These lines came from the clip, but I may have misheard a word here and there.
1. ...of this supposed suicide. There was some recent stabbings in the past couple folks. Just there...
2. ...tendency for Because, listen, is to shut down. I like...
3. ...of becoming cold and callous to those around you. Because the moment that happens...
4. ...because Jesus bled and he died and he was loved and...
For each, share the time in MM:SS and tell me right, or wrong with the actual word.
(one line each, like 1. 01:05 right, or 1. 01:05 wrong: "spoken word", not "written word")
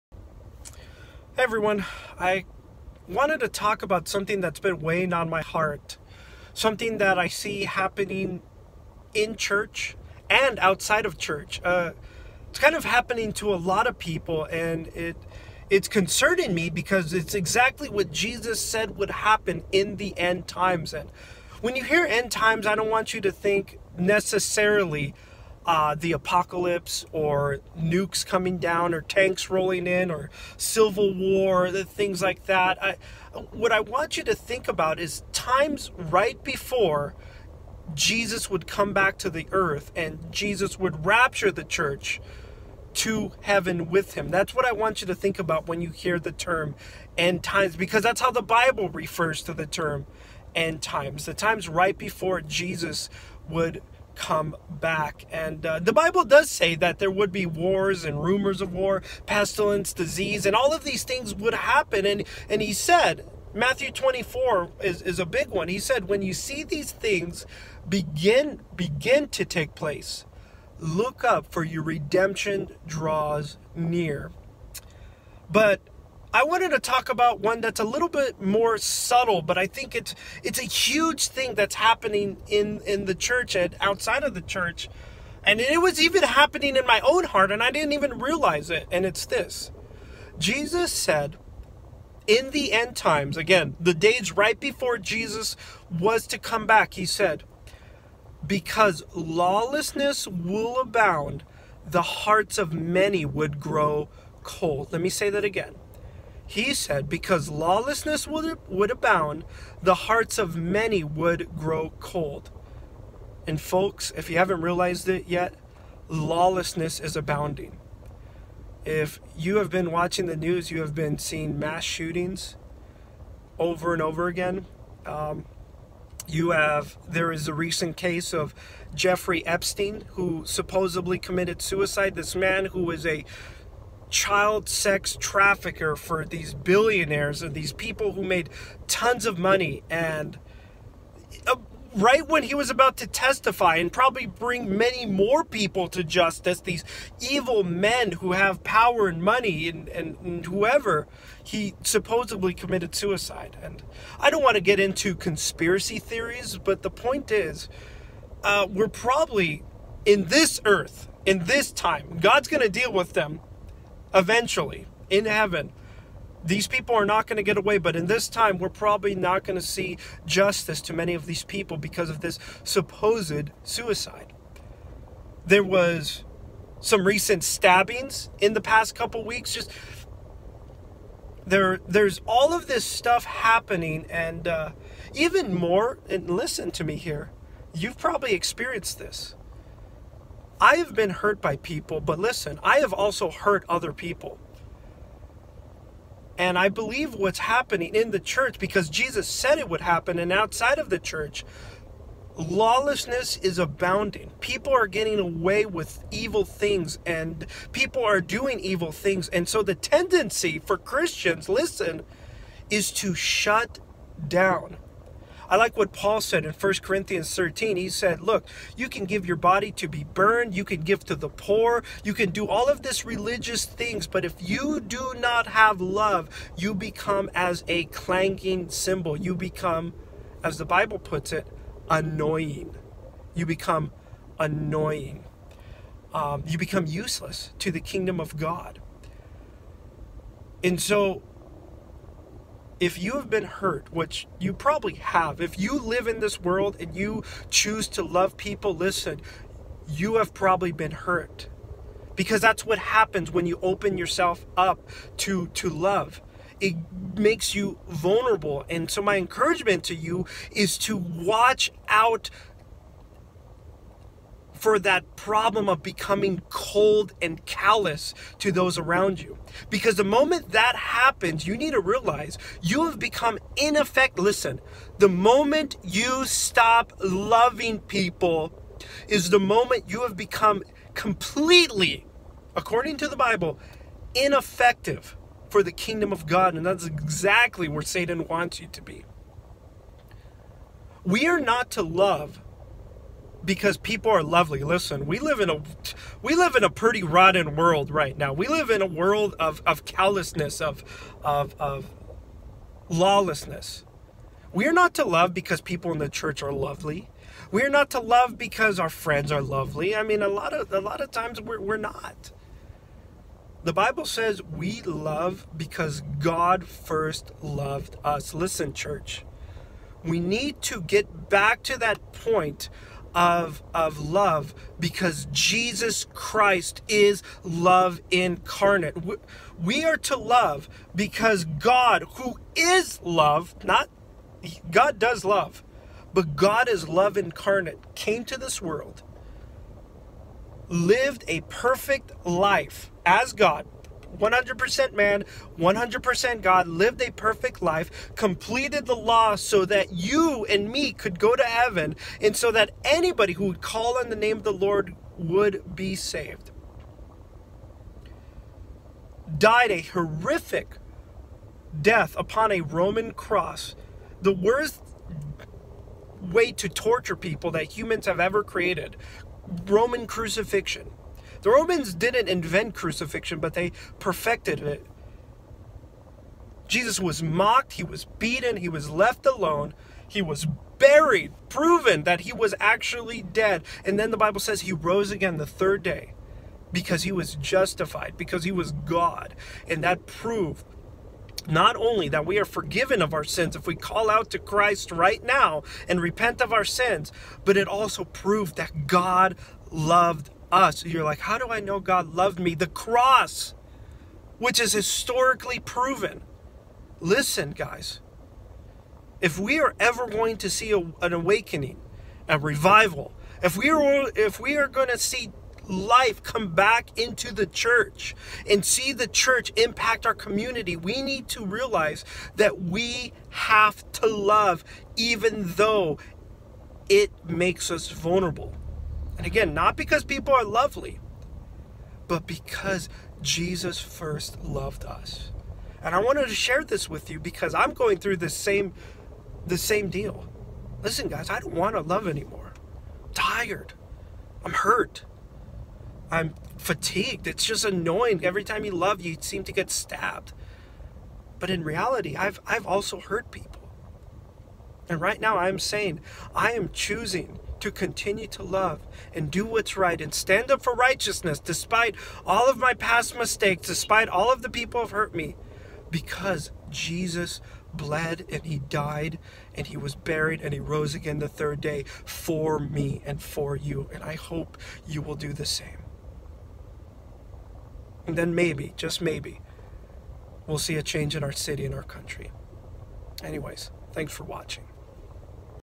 1. 02:52 wrong: "weeks", not "folks"
2. 03:29 wrong: "Christians", not "Because"
3. 04:25 right
4. 07:45 wrong: "buried", not "loved".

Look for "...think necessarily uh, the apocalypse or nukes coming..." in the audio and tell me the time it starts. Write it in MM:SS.
00:23.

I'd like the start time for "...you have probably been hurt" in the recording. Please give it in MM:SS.
04:09.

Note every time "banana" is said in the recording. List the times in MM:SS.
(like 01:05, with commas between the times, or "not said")
not said.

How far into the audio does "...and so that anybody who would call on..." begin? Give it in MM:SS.
05:52.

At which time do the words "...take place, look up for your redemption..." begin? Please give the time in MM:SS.
01:09.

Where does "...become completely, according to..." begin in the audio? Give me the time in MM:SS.
04:40.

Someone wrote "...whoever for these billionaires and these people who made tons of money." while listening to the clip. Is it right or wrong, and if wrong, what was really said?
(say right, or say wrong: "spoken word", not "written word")
wrong: "trafficker", not "whoever".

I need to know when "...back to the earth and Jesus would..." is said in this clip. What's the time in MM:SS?
00:38.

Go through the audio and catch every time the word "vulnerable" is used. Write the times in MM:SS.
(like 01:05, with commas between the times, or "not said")
04:17, 07:07.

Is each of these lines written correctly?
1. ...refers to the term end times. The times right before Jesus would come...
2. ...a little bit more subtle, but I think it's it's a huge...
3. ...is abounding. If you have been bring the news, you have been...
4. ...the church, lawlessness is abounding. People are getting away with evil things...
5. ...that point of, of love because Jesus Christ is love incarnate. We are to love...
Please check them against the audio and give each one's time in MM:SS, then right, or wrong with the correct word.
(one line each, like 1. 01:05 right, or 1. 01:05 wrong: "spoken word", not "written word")
1. 00:48 right
2. 01:17 right
3. 01:56 wrong: "watching", not "bring"
4. 03:20 right
5. 05:21 right.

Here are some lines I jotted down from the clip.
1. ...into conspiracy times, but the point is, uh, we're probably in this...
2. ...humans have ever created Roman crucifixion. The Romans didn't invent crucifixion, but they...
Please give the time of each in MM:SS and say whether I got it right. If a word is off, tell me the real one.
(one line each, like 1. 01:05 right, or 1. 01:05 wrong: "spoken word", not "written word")
1. 02:34 wrong: "theories", not "times"
2. 06:07 right.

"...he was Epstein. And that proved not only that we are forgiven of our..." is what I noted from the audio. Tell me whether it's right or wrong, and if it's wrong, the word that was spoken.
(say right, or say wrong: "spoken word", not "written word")
wrong: "God", not "Epstein".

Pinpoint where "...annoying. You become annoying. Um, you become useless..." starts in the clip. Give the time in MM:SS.
03:51.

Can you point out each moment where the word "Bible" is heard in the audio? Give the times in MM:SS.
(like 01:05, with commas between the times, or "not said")
00:48, 00:55, 03:50, 04:43, 05:13, 06:24.